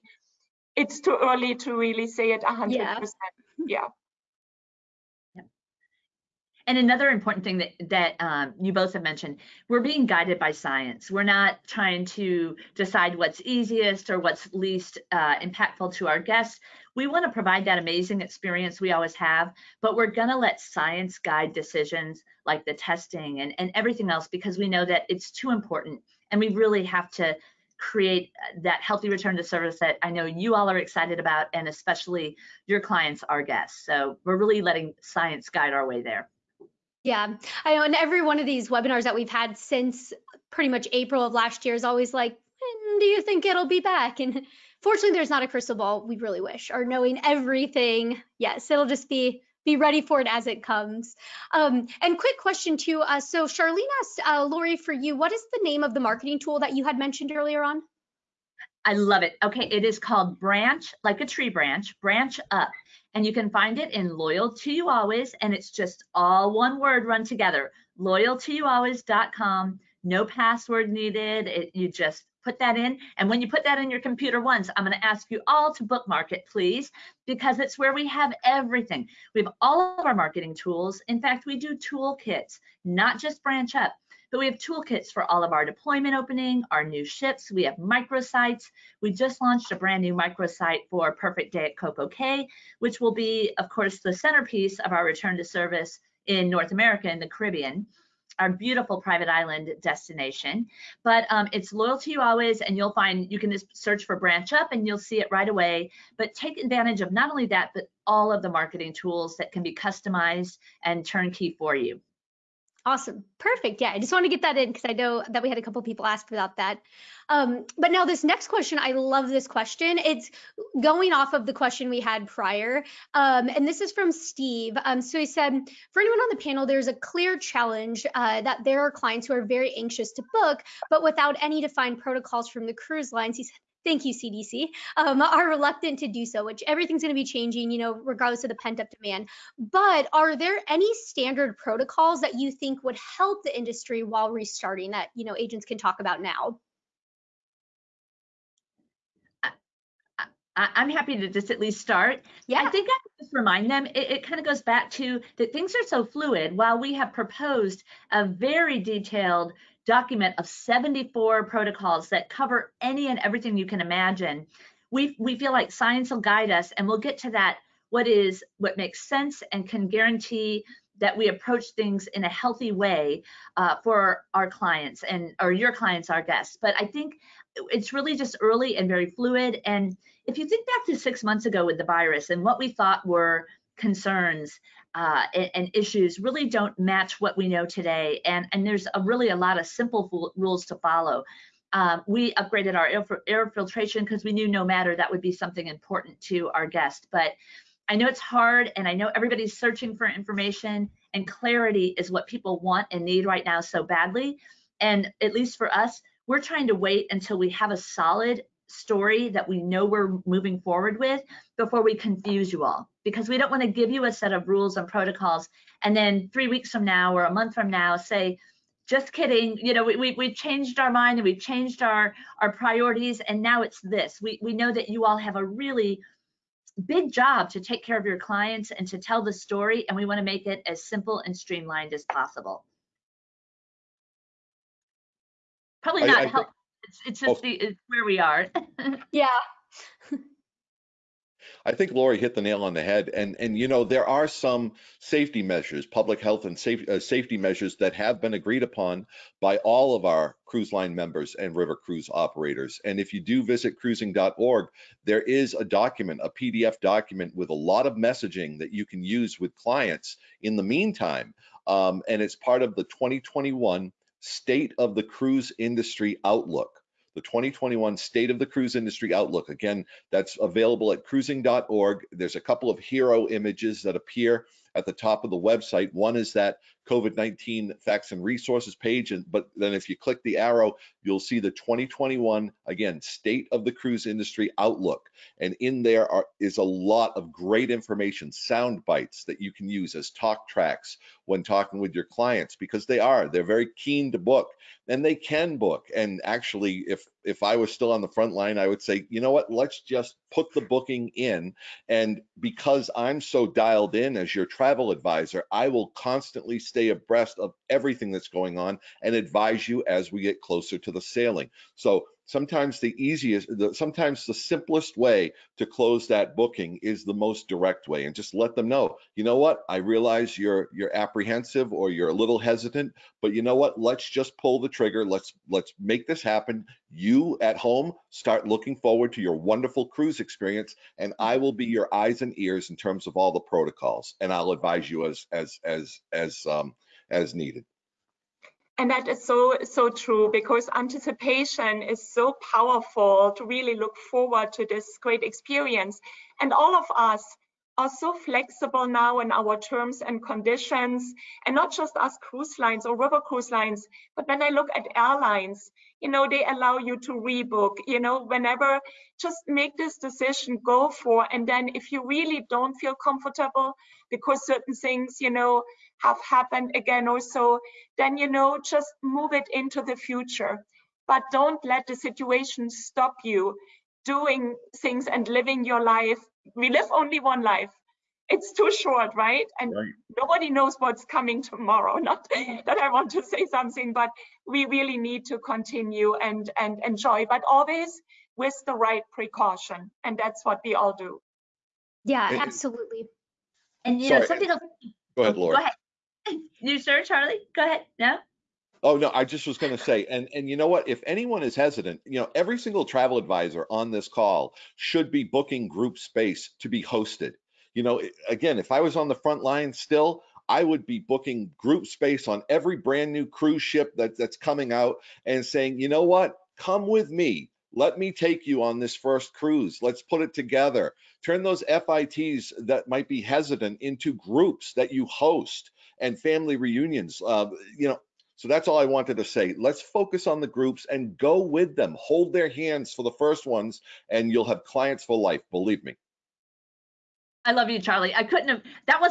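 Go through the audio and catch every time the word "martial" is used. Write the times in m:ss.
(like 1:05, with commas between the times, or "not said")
not said.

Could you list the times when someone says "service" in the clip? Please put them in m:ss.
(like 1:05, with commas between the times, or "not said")
0:29, 1:35.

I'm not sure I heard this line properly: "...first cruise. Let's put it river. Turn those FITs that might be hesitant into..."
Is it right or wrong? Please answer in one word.
wrong.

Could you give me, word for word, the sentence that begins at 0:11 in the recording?
We're not trying to decide what's easiest or what's least uh, impactful to our guests.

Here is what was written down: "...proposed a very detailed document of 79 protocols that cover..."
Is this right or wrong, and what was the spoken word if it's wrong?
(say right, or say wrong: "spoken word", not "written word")
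wrong: "74", not "79".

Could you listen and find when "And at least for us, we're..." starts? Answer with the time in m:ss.
3:24.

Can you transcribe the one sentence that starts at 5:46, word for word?
And all of us are so flexible now in our terms and conditions.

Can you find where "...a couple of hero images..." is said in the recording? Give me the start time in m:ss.
4:32.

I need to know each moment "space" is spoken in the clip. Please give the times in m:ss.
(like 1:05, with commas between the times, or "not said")
6:45, 6:51.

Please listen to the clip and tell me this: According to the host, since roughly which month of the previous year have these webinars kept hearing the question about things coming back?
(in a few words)
April.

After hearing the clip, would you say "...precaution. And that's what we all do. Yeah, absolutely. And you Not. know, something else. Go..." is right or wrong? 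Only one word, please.
wrong.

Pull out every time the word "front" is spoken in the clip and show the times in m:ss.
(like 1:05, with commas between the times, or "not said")
4:58, 6:49.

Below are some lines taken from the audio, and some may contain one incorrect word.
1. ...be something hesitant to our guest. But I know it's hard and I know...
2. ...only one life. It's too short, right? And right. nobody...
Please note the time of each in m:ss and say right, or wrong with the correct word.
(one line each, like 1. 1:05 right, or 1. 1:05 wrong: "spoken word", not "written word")
1. 3:15 wrong: "important", not "hesitant"
2. 6:16 right.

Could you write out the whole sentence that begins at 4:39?
And but then if you click the arrow, you'll see the 2021 again state of the cruise industry outlook.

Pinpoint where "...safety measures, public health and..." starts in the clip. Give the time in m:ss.
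4:04.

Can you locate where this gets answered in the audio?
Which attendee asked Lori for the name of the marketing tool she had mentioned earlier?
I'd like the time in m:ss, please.
0:53.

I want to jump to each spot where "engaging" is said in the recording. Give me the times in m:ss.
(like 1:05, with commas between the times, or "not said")
not said.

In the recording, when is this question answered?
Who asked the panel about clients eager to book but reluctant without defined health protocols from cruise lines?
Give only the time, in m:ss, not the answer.
2:04.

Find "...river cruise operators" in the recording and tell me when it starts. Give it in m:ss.
4:11.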